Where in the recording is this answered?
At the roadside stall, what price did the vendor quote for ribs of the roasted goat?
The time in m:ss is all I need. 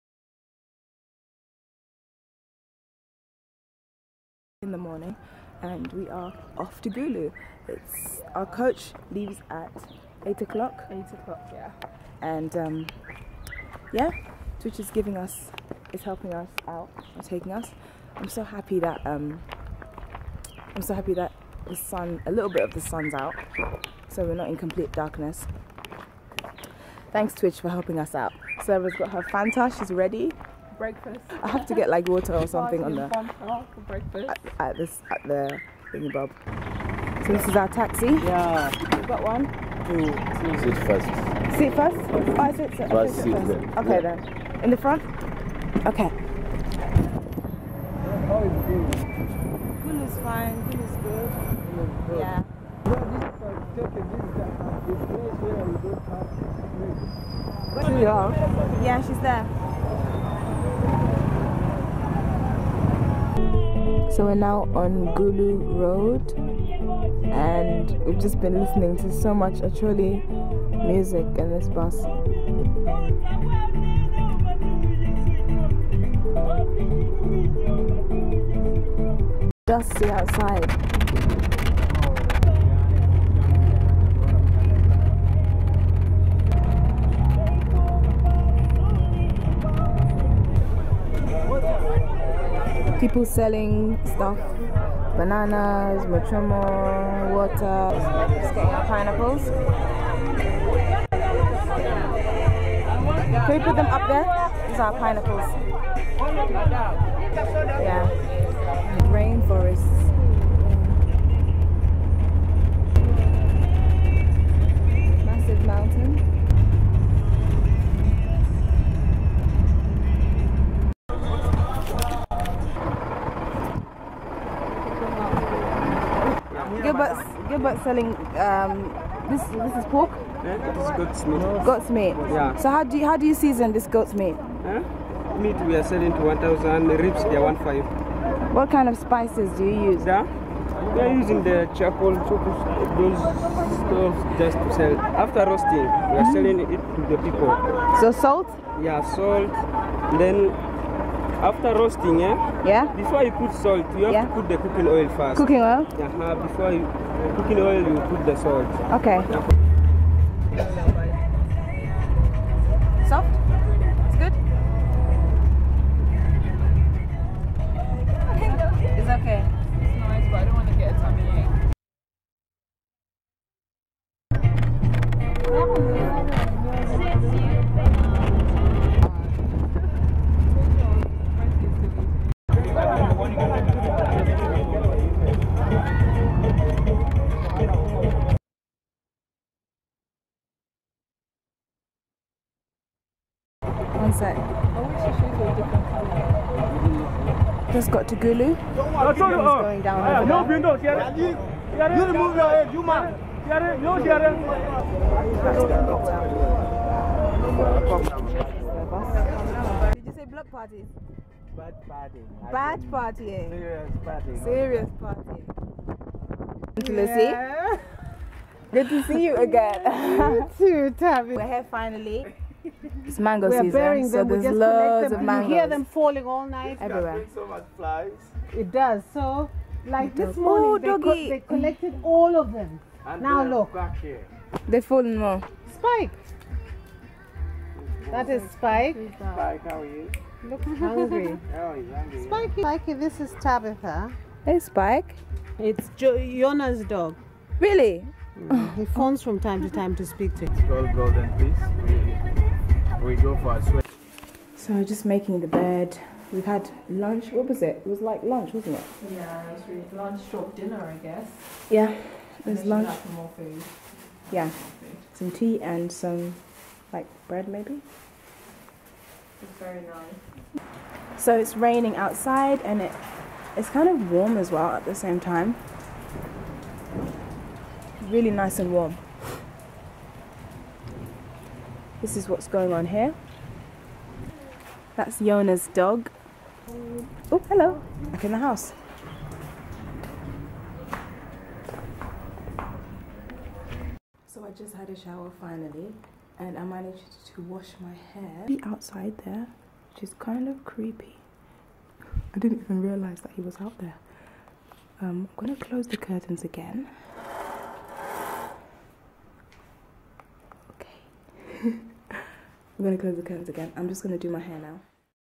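2:17.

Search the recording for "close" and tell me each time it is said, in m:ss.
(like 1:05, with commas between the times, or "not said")
5:05, 5:13.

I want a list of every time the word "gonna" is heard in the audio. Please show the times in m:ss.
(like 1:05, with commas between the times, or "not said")
5:05.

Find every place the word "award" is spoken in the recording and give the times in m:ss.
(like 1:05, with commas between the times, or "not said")
not said.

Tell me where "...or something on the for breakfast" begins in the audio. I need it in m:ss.
0:32.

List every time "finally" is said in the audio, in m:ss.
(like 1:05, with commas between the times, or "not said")
3:41, 4:55.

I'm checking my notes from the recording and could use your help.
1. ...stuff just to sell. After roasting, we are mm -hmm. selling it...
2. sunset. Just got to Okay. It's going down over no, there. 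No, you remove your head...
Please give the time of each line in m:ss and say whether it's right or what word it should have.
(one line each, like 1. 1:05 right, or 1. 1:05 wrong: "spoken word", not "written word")
1. 2:23 right
2. 3:14 wrong: "Gulu", not "Okay".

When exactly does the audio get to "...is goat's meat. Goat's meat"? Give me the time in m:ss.
2:10.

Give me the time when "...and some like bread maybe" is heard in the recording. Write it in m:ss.
4:25.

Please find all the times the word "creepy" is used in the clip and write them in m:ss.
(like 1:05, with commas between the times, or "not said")
5:00.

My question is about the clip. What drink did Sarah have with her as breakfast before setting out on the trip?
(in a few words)
Fanta.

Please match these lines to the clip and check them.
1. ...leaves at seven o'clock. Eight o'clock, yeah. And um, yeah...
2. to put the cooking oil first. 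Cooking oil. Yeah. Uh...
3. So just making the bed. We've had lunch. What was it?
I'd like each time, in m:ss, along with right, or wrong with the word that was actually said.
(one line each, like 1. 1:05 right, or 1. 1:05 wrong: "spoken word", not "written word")
1. 0:09 wrong: "eight", not "seven"
2. 2:34 right
3. 4:14 right.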